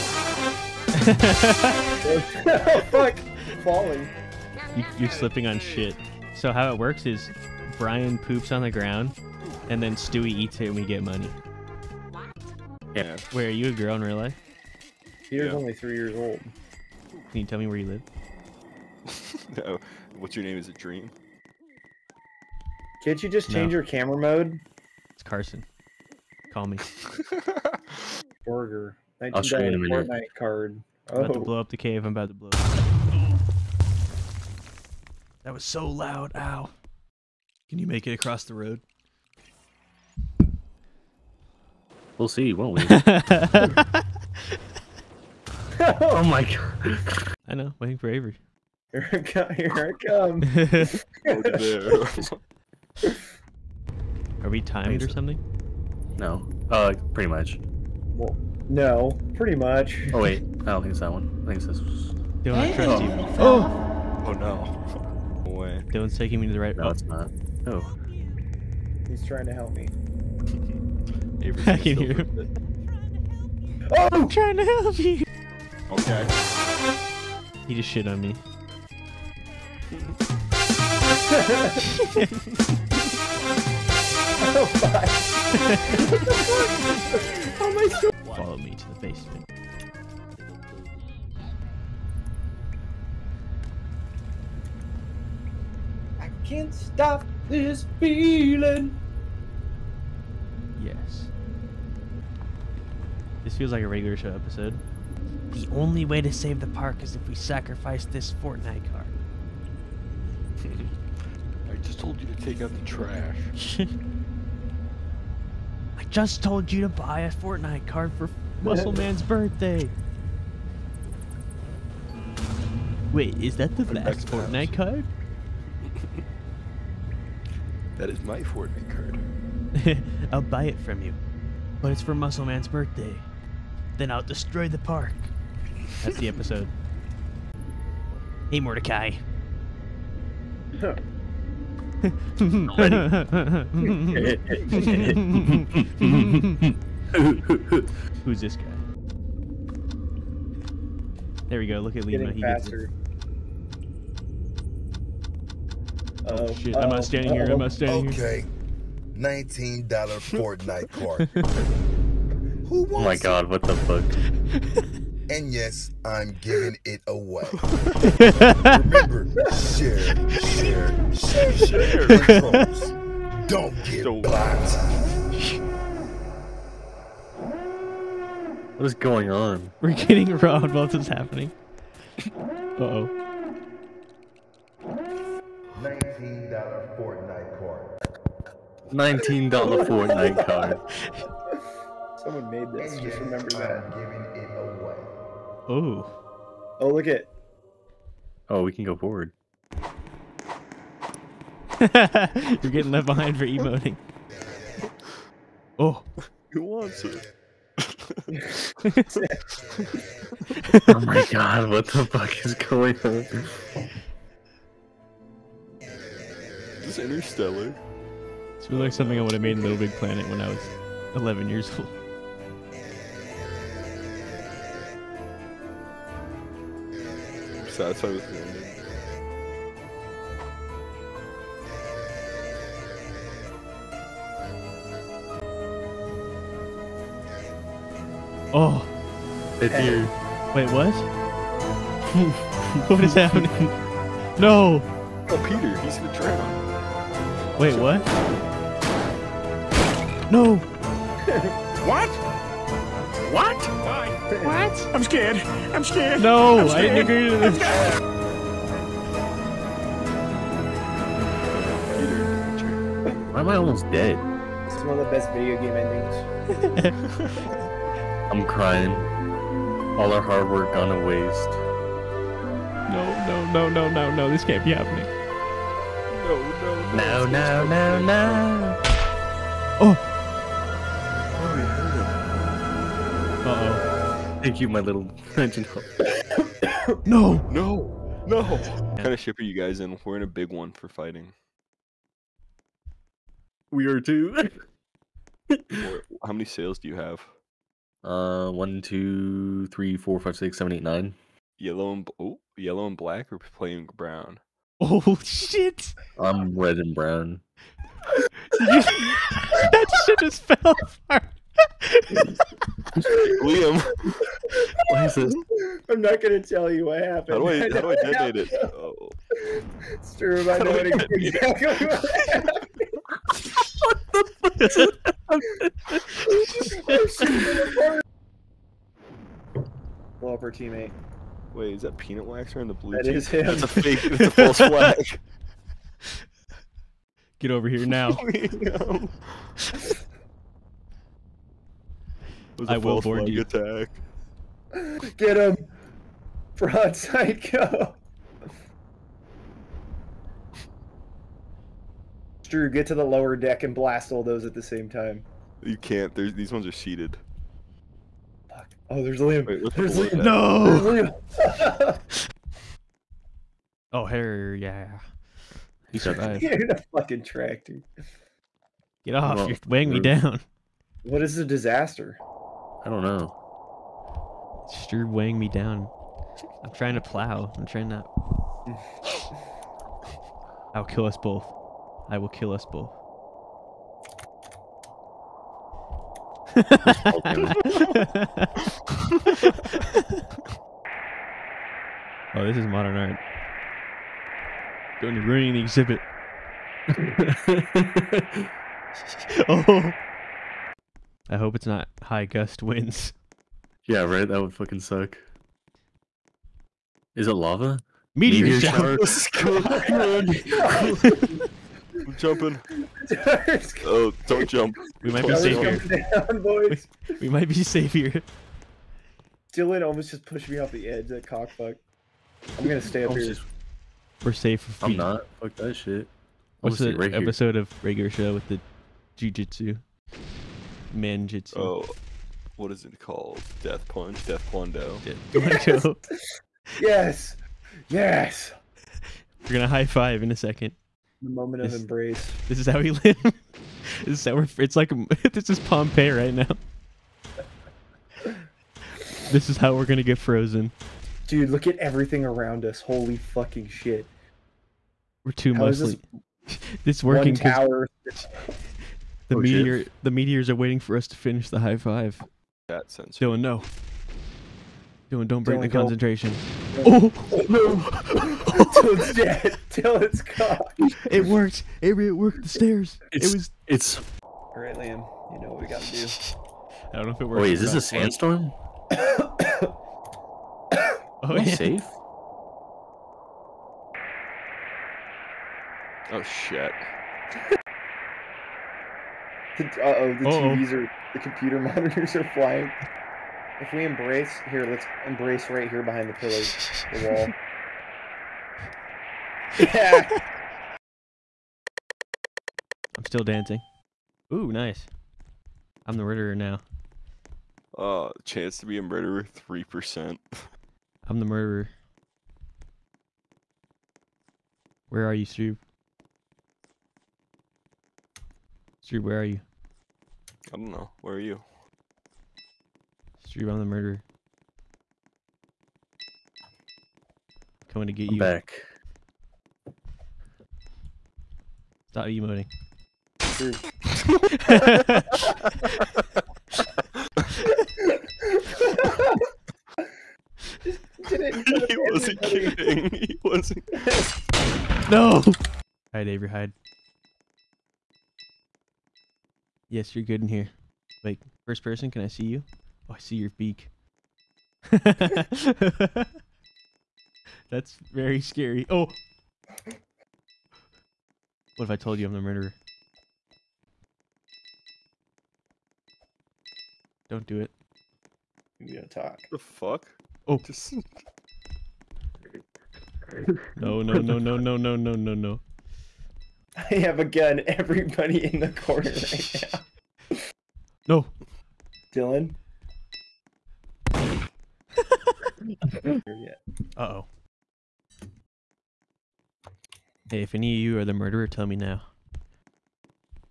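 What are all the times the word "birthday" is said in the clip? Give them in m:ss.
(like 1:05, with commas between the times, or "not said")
1:59, 2:12.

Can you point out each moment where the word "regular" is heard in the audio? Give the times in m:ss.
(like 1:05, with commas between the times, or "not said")
1:43, 7:07.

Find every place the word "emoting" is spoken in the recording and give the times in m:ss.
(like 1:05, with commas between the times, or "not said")
3:23, 8:52.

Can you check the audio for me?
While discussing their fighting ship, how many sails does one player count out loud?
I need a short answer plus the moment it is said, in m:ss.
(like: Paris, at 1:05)
9, at 5:00.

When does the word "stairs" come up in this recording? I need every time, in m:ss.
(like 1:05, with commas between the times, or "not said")
7:52.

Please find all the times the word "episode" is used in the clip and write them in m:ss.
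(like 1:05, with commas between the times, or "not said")
1:44, 2:16, 7:07.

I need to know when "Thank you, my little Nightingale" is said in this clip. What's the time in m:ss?
4:44.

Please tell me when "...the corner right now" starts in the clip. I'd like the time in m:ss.
9:38.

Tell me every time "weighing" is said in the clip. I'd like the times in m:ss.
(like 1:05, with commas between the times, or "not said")
6:09, 6:15.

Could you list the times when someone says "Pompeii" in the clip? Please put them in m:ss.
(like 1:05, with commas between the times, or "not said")
7:25.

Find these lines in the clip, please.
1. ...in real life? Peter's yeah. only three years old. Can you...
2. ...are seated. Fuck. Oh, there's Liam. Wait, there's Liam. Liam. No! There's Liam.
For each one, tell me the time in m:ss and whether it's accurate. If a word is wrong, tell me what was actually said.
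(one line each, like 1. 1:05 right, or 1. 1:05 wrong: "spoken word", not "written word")
1. 0:13 right
2. 5:56 right.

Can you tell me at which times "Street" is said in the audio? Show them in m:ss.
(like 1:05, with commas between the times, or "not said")
8:38, 8:43.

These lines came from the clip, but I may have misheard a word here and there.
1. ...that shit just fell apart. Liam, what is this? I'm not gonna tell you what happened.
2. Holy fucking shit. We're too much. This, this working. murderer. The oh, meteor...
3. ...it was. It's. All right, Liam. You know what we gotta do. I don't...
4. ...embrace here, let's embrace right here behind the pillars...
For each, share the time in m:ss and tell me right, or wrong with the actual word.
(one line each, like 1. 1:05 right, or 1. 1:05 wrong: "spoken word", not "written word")
1. 5:08 right
2. 7:32 wrong: "tower", not "murderer"
3. 7:53 right
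4. 8:13 right.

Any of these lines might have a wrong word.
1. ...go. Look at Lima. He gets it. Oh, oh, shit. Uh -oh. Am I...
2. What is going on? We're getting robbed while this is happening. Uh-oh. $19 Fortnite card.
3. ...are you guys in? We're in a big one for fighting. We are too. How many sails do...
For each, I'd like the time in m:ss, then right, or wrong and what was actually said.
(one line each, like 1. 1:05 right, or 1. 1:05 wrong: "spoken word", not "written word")
1. 2:31 right
2. 2:58 right
3. 4:49 right.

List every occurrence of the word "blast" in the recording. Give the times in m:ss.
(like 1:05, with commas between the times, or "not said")
5:53.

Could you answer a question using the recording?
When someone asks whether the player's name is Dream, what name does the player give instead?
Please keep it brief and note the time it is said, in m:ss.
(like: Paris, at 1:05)
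Carson, at 0:25.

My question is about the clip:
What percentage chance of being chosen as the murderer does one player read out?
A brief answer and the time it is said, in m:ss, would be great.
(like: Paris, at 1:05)
3%, at 8:29.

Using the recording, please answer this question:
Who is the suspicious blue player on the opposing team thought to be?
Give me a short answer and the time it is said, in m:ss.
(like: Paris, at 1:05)
Peanut Waxer, at 5:31.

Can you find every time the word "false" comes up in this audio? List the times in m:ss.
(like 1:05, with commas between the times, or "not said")
5:34, 5:42.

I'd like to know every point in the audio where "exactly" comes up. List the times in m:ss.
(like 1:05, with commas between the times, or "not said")
5:20.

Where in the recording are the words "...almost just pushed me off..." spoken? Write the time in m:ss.
6:59.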